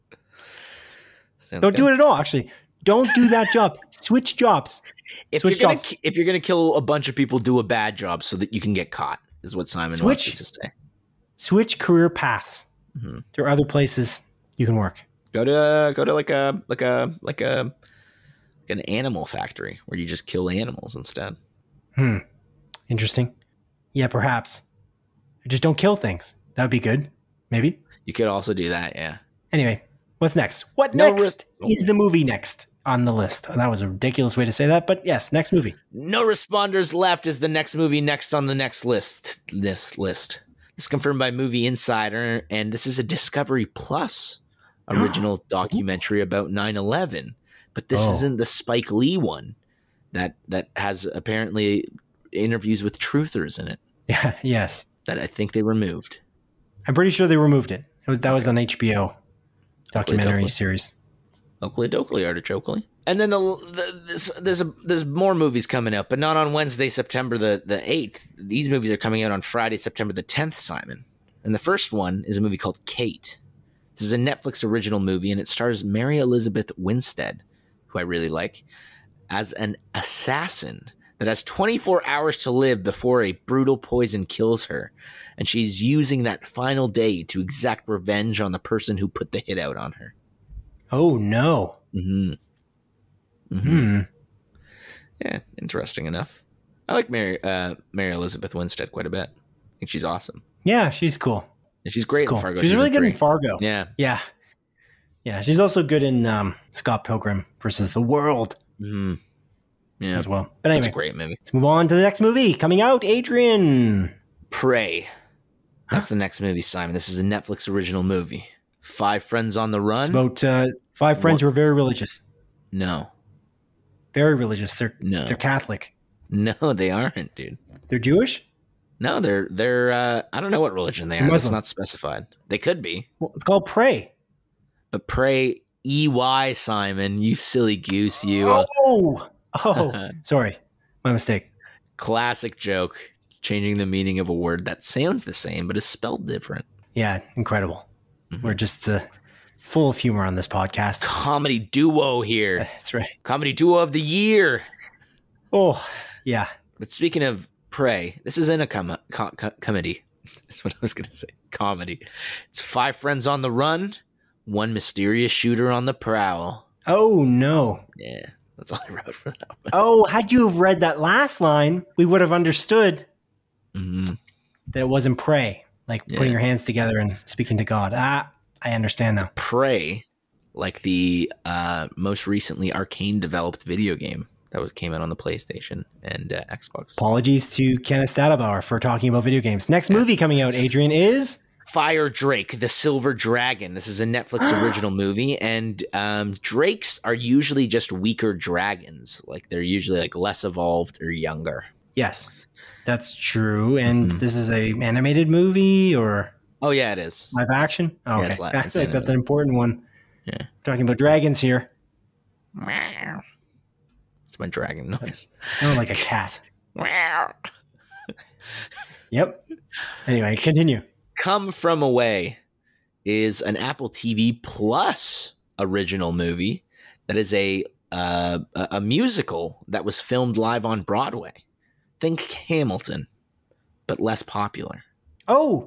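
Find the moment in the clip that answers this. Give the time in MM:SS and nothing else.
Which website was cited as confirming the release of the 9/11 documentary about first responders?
00:41.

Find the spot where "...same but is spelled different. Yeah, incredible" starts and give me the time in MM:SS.
02:25.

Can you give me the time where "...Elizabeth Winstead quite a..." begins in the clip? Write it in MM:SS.
01:38.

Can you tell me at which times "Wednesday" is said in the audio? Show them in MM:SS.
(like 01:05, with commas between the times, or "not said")
01:06.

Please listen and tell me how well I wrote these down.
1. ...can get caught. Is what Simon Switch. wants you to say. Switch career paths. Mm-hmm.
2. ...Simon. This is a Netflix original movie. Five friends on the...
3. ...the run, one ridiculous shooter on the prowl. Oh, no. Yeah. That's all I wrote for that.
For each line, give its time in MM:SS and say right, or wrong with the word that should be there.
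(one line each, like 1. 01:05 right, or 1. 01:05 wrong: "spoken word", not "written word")
1. 00:08 right
2. 01:56 right
3. 02:43 wrong: "mysterious", not "ridiculous".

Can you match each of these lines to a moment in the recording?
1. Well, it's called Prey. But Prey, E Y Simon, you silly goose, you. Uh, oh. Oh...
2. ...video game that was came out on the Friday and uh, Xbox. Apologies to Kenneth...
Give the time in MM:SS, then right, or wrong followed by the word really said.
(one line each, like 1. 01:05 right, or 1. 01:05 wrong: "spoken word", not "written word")
1. 02:13 right
2. 03:03 wrong: "PlayStation", not "Friday".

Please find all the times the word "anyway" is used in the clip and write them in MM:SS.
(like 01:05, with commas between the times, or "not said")
00:29, 01:50, 03:40.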